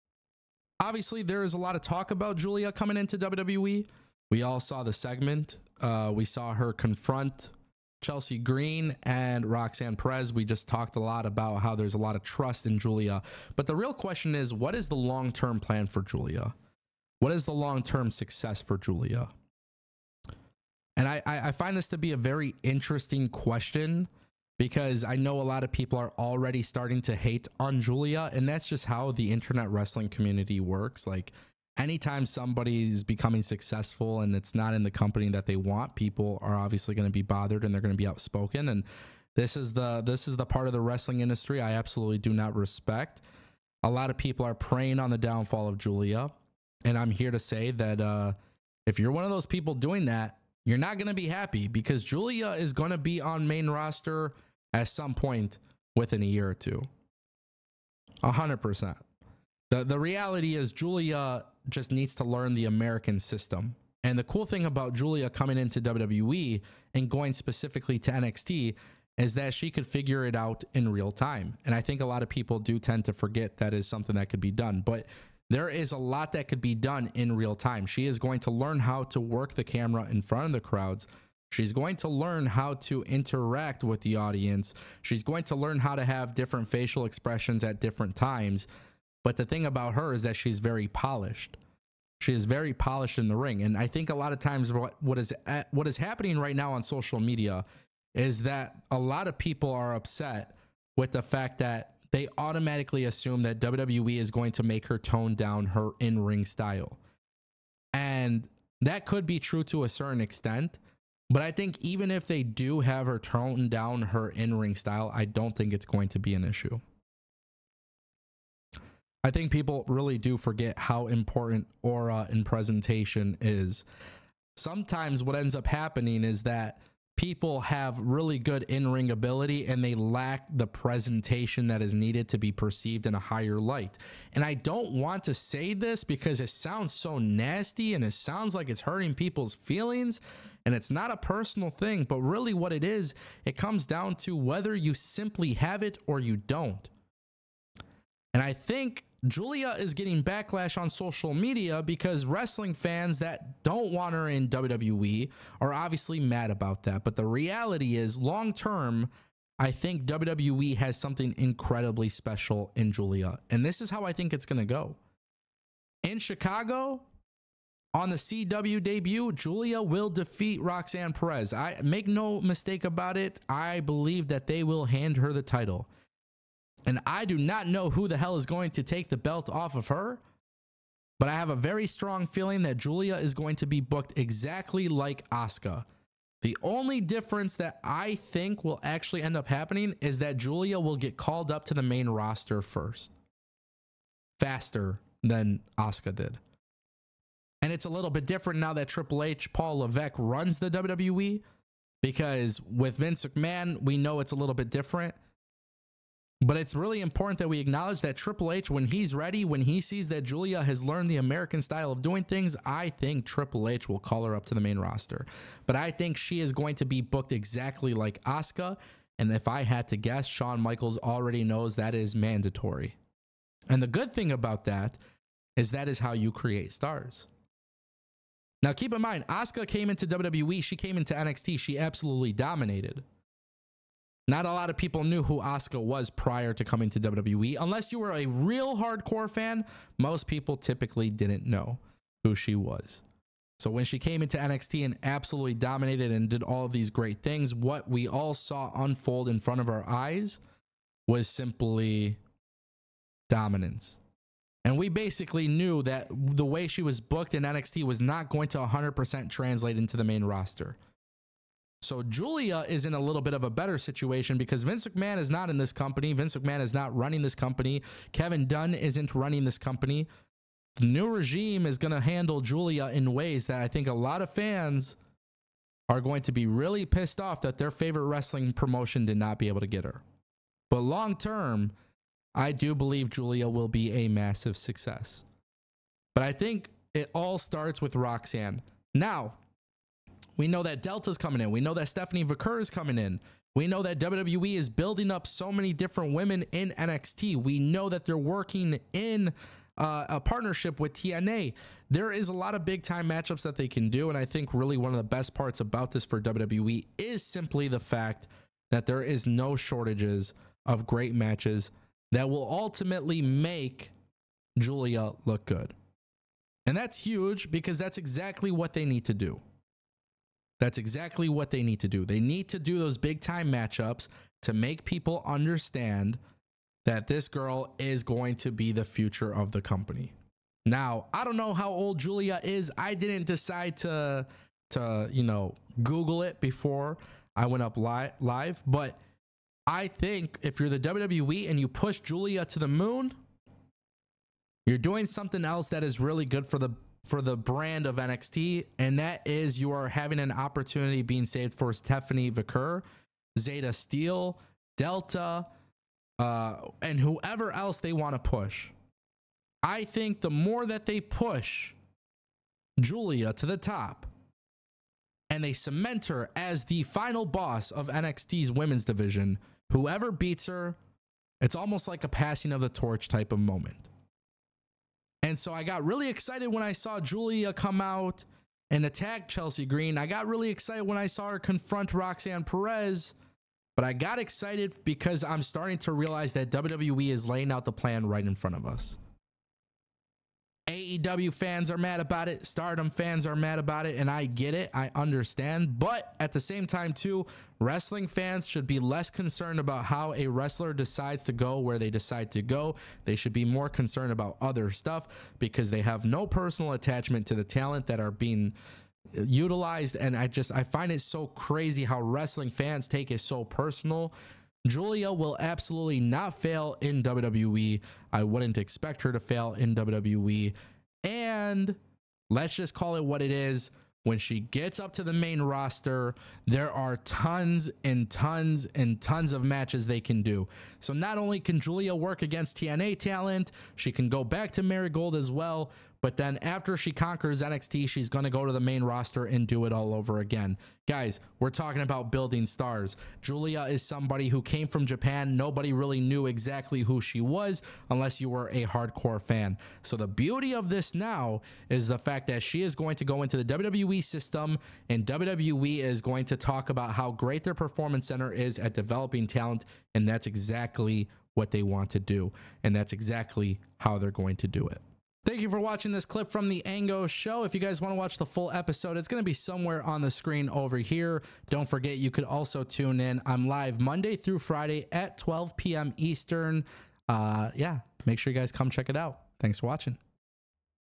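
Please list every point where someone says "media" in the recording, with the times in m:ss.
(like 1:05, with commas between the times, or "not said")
1:37, 2:31.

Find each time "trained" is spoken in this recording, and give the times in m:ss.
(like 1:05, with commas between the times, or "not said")
not said.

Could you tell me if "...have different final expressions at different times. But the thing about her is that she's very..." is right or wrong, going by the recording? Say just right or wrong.
wrong.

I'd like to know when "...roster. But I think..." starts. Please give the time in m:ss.
3:34.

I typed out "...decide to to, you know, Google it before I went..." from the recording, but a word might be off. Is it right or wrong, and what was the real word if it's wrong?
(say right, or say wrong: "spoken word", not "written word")
right.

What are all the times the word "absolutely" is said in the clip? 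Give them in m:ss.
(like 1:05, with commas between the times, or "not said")
0:41, 3:51, 4:05, 6:55.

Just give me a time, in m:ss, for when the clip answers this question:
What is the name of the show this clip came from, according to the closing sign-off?
7:46.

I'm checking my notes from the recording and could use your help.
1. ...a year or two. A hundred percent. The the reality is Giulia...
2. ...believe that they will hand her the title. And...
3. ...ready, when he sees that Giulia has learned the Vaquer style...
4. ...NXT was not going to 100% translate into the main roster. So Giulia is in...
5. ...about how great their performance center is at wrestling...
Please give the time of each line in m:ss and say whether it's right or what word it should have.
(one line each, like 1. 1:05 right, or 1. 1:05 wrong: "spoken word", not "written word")
1. 0:56 right
2. 2:53 right
3. 3:29 wrong: "American", not "Vaquer"
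4. 4:17 right
5. 7:36 wrong: "developing", not "wrestling".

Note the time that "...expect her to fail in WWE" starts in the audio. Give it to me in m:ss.
6:58.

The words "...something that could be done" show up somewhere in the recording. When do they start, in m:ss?
1:13.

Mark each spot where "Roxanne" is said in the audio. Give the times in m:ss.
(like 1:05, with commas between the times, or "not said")
0:09, 2:50, 4:47, 6:21.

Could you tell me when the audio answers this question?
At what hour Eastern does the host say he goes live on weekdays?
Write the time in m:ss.
7:55.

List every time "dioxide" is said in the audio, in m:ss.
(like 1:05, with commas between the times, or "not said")
not said.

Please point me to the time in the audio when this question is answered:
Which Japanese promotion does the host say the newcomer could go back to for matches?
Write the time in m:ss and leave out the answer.
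7:14.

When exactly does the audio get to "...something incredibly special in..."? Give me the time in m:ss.
2:40.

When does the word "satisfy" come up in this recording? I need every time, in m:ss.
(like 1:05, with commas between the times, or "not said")
not said.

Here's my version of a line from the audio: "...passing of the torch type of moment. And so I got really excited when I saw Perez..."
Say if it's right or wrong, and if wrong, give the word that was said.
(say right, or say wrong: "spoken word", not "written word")
wrong: "Giulia", not "Perez".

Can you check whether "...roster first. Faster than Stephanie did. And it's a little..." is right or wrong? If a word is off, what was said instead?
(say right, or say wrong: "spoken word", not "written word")
wrong: "Asuka", not "Stephanie".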